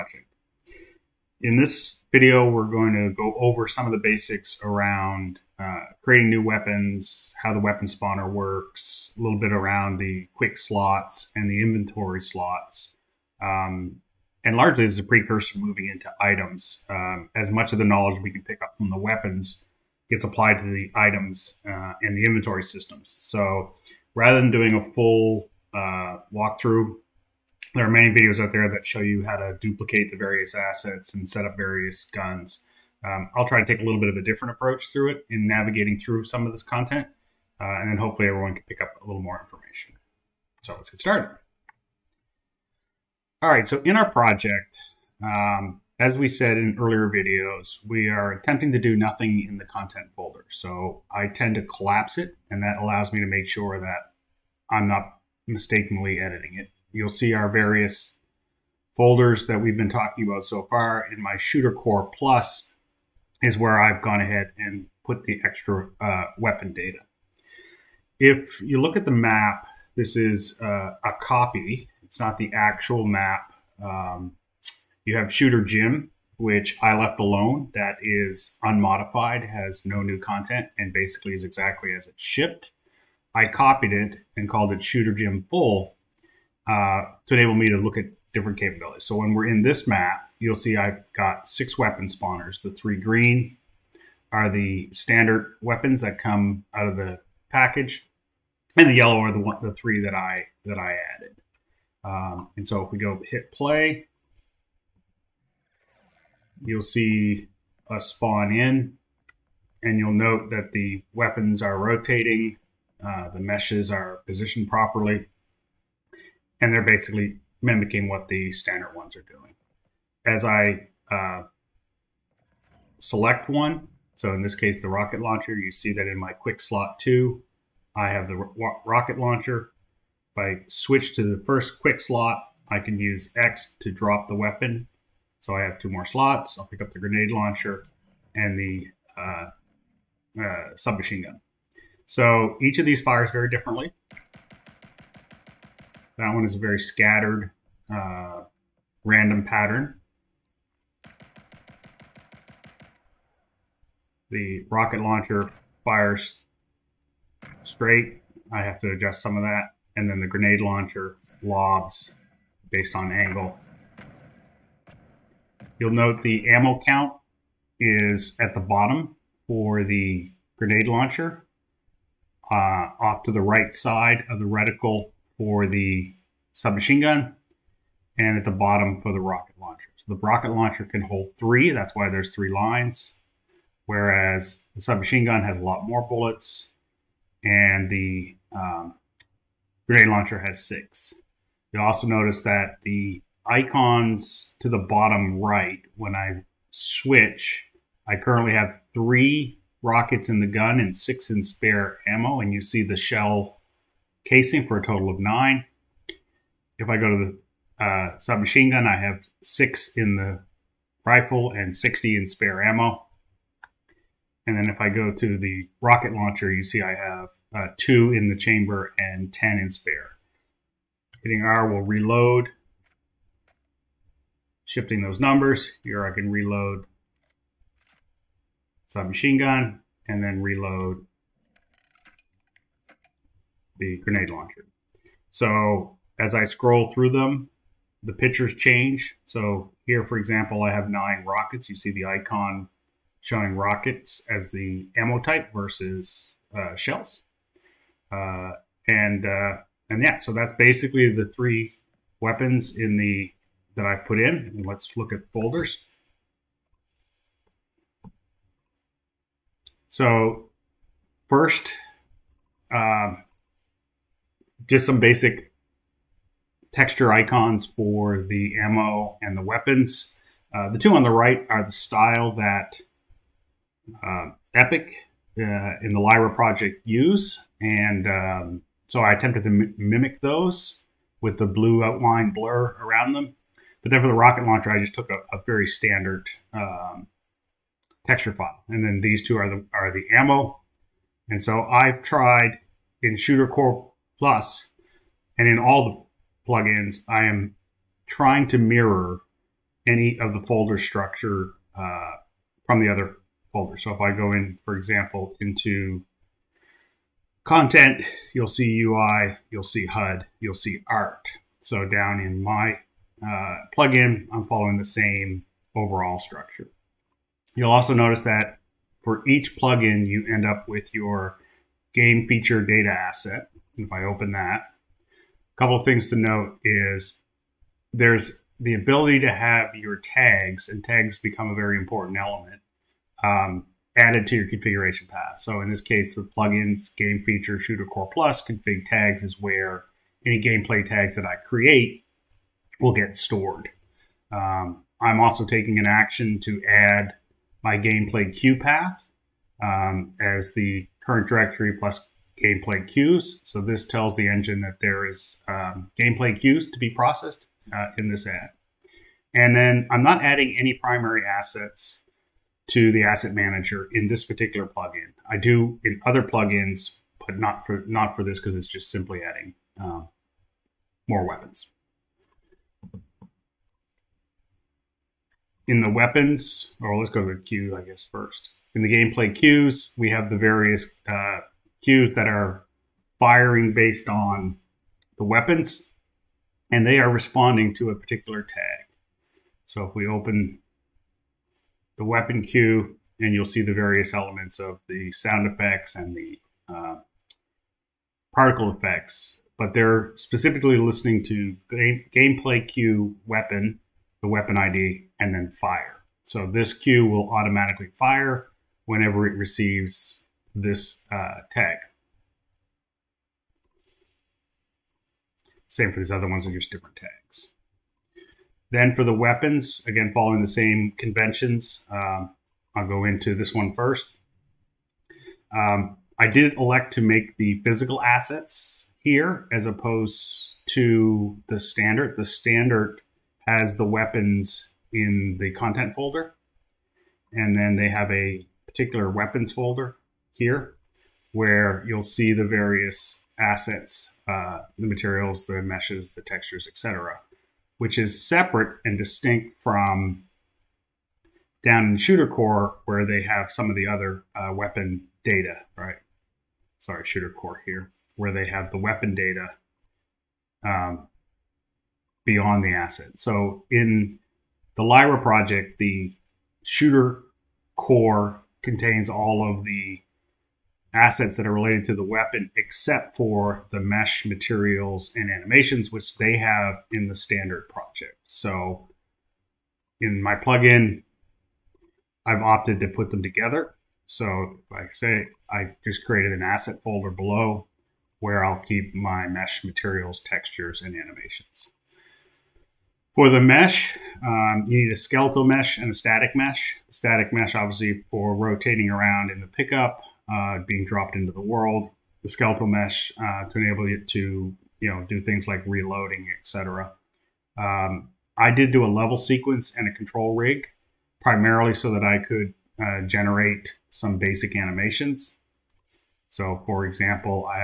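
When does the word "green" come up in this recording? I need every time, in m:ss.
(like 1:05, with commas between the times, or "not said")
1:32.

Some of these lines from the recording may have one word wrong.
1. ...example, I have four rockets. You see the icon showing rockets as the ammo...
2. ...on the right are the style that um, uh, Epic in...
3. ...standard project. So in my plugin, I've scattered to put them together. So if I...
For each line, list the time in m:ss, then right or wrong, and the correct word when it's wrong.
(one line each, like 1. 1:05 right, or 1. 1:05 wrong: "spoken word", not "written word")
1. 4:00 wrong: "nine", not "four"
2. 4:30 right
3. 7:57 wrong: "opted", not "scattered".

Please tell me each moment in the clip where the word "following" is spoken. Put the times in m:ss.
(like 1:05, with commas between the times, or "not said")
5:14, 7:00.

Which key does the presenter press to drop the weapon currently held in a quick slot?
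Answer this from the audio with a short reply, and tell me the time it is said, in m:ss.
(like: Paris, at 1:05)
X, at 2:13.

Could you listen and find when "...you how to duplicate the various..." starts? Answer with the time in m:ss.
0:29.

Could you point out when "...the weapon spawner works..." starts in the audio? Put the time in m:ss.
0:07.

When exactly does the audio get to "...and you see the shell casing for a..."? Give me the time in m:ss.
3:22.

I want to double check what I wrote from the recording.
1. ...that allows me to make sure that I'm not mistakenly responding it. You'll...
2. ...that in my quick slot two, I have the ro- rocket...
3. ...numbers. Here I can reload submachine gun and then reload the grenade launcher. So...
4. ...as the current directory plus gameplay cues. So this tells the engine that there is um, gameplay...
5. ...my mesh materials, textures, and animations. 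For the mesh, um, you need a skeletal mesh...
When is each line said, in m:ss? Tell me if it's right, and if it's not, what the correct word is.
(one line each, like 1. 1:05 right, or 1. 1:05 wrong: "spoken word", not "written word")
1. 0:52 wrong: "editing", not "responding"
2. 2:05 right
3. 3:45 right
4. 5:50 right
5. 8:08 right.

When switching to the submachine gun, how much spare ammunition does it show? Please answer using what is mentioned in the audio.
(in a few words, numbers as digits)
60.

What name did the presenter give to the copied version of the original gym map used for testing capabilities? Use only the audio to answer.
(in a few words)
Shooter Gym Full.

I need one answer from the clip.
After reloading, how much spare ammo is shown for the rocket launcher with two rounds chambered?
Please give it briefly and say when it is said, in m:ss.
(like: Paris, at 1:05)
10, at 3:39.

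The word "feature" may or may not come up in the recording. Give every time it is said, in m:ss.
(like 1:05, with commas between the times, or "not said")
5:22, 5:37.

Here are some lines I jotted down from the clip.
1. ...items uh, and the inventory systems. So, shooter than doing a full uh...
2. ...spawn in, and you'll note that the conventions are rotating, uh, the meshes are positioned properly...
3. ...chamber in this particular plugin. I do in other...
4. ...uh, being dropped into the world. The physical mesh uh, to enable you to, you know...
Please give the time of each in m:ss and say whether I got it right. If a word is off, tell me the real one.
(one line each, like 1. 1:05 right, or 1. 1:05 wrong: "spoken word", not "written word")
1. 0:20 wrong: "rather", not "shooter"
2. 1:48 wrong: "weapons", not "conventions"
3. 6:03 wrong: "manager", not "chamber"
4. 8:20 wrong: "skeletal", not "physical".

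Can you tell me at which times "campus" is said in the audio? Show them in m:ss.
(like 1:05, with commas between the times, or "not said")
not said.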